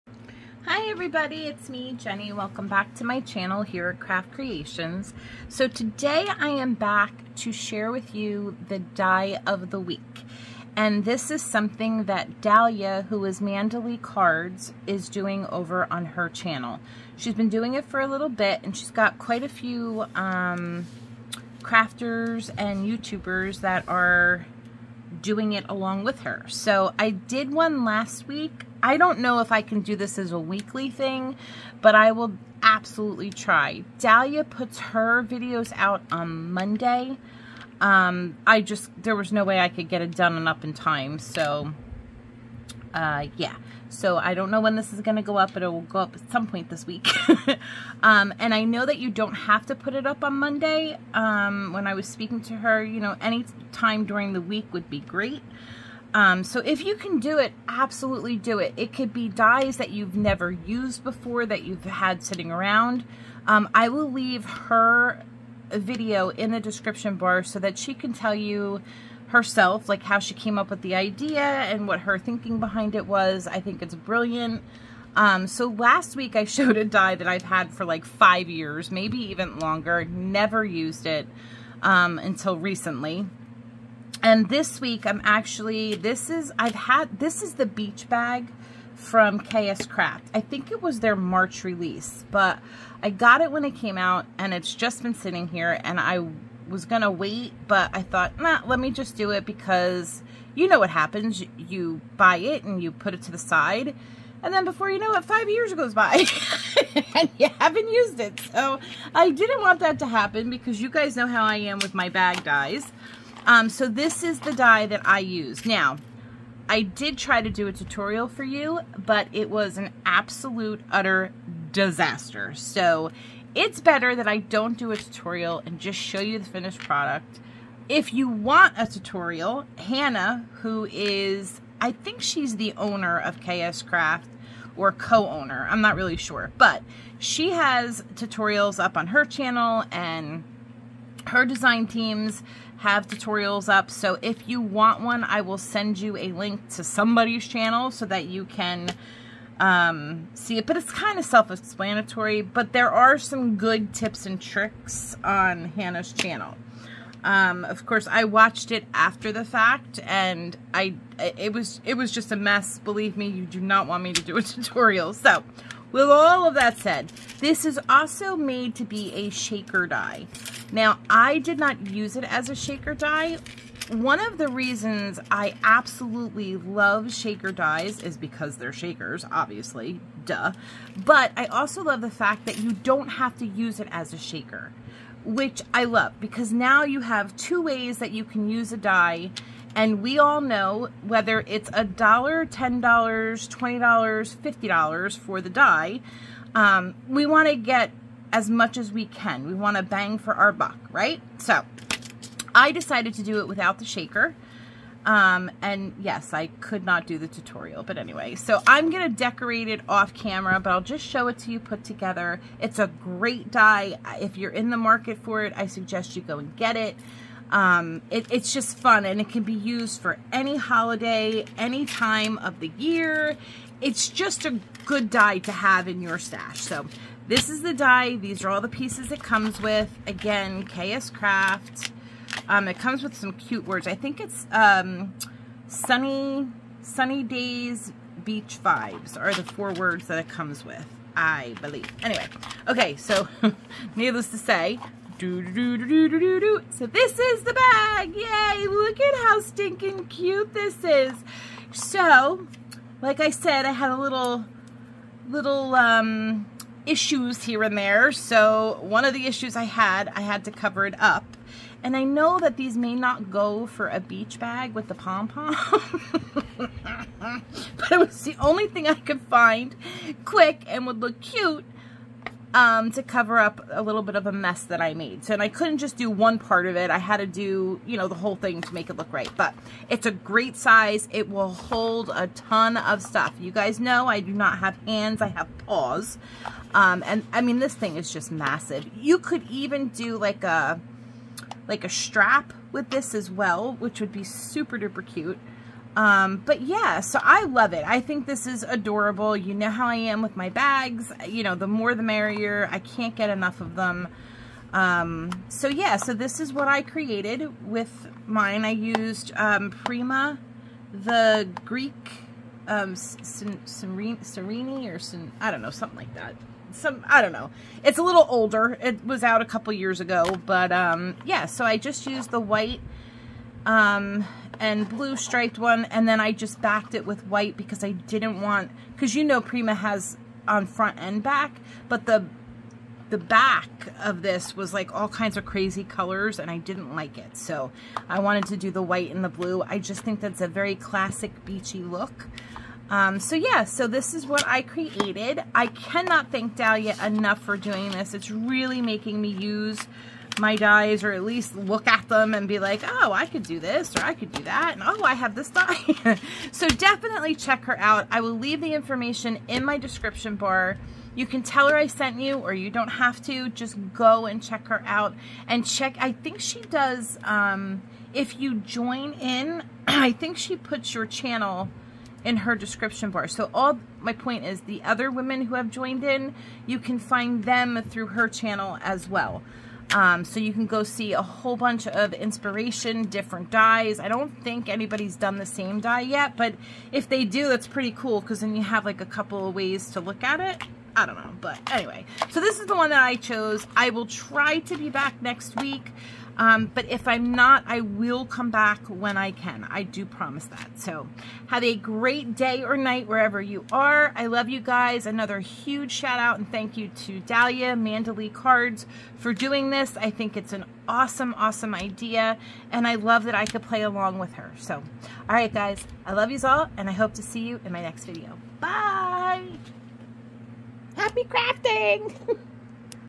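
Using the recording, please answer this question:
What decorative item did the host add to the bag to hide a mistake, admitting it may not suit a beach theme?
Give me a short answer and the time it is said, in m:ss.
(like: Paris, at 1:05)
pom-pom, at 4:24.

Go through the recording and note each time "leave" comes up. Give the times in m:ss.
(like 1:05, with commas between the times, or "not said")
1:04, 5:58.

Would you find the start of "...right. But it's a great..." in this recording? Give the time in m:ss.
4:39.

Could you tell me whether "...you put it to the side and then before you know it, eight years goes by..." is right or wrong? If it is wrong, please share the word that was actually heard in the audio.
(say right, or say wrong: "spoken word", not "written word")
wrong: "five", not "eight".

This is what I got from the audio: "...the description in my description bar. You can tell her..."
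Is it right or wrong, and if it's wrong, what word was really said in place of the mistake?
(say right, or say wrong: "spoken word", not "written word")
wrong: "information", not "description".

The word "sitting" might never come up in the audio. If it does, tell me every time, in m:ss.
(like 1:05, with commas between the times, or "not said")
1:02, 1:35.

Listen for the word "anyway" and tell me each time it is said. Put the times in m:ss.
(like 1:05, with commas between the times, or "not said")
3:27, 4:02, 6:31.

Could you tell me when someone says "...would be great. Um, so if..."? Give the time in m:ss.
0:54.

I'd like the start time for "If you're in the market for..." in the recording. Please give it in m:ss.
3:34.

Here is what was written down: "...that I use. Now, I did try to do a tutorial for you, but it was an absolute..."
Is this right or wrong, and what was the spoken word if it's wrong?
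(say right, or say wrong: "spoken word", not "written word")
right.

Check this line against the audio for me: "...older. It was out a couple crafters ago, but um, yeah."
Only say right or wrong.
wrong.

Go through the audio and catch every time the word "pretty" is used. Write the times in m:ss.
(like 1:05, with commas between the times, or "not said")
6:27.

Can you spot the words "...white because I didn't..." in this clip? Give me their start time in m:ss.
5:27.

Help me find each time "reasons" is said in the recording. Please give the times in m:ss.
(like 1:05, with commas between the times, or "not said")
2:54.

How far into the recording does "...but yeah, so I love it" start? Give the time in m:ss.
4:56.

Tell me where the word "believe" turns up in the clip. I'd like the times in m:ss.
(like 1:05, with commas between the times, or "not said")
2:42, 4:01.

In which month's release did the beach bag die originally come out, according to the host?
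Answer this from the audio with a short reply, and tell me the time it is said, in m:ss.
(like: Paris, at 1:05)
March, at 1:31.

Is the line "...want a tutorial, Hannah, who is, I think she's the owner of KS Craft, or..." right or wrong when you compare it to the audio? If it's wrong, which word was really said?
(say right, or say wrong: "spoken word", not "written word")
right.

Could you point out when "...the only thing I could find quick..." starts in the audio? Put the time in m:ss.
4:28.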